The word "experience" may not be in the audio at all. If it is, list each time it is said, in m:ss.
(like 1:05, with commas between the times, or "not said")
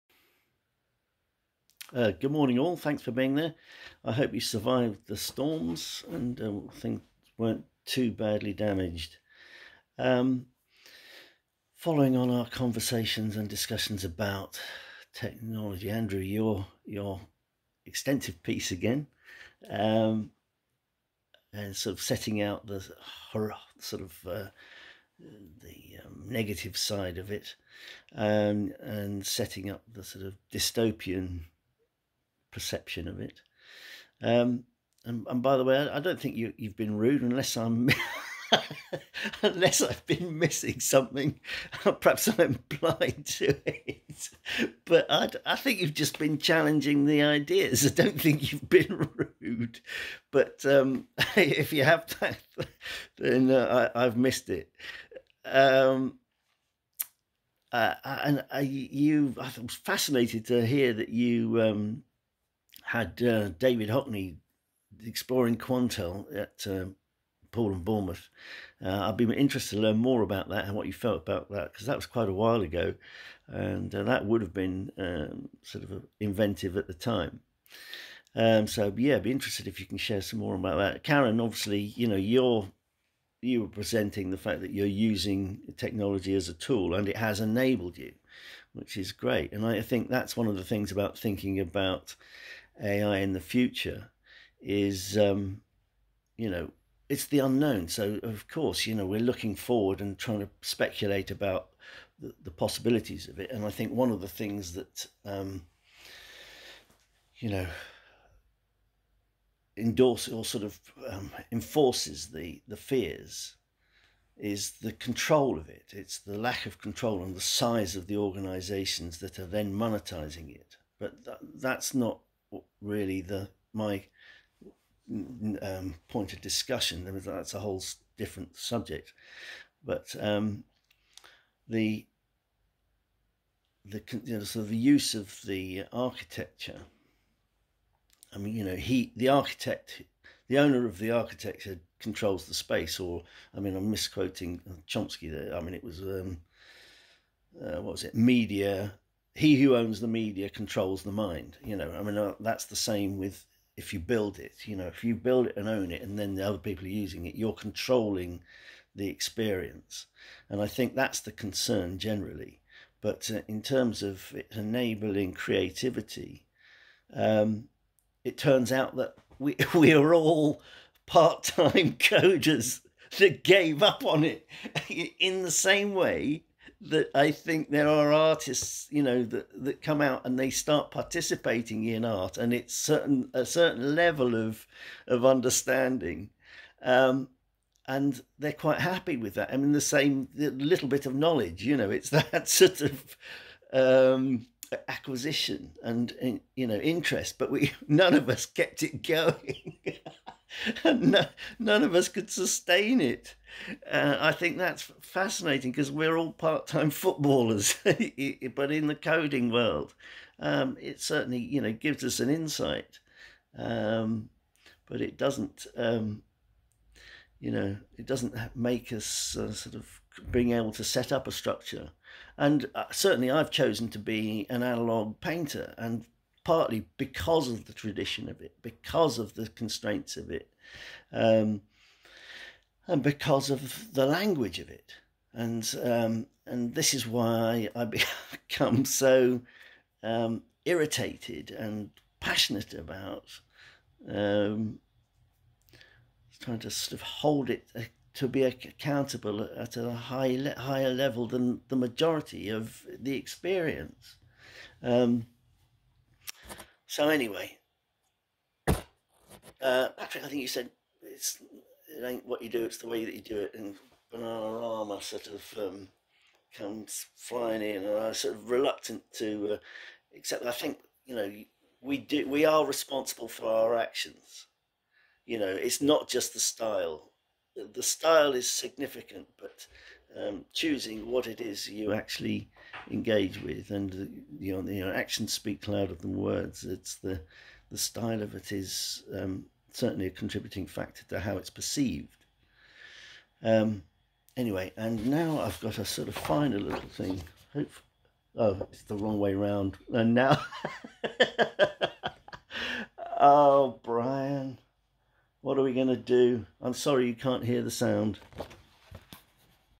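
2:39, 4:13.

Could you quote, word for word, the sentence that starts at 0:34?
Um, and, and, by the way, I, don't think you, have been rude unless I'm.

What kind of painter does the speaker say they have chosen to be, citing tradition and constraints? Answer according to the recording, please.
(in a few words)
analog painter.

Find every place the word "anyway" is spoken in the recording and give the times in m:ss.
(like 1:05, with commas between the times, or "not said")
4:17, 4:54.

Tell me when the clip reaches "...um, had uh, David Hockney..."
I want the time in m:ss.
1:01.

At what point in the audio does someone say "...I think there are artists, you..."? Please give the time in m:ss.
2:57.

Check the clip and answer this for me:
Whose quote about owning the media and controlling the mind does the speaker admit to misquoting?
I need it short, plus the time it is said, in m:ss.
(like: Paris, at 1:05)
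Chomsky, at 2:24.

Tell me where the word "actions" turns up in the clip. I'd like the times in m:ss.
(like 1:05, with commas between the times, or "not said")
4:33, 4:44.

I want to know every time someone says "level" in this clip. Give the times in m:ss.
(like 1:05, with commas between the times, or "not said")
3:03, 4:10.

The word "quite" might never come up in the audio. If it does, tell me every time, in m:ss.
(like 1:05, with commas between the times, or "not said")
1:12, 3:08.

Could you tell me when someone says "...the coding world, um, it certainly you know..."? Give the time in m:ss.
3:28.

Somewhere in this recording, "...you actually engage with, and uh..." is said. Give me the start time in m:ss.
4:41.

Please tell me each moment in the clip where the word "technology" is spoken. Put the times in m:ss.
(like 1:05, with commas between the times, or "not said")
0:15, 1:25.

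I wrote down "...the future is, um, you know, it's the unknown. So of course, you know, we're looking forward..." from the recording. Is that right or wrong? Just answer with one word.
right.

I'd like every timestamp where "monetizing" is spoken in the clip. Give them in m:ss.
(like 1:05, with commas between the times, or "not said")
1:59.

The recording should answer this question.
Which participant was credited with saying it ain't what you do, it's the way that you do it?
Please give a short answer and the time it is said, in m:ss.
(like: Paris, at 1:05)
Patrick, at 4:19.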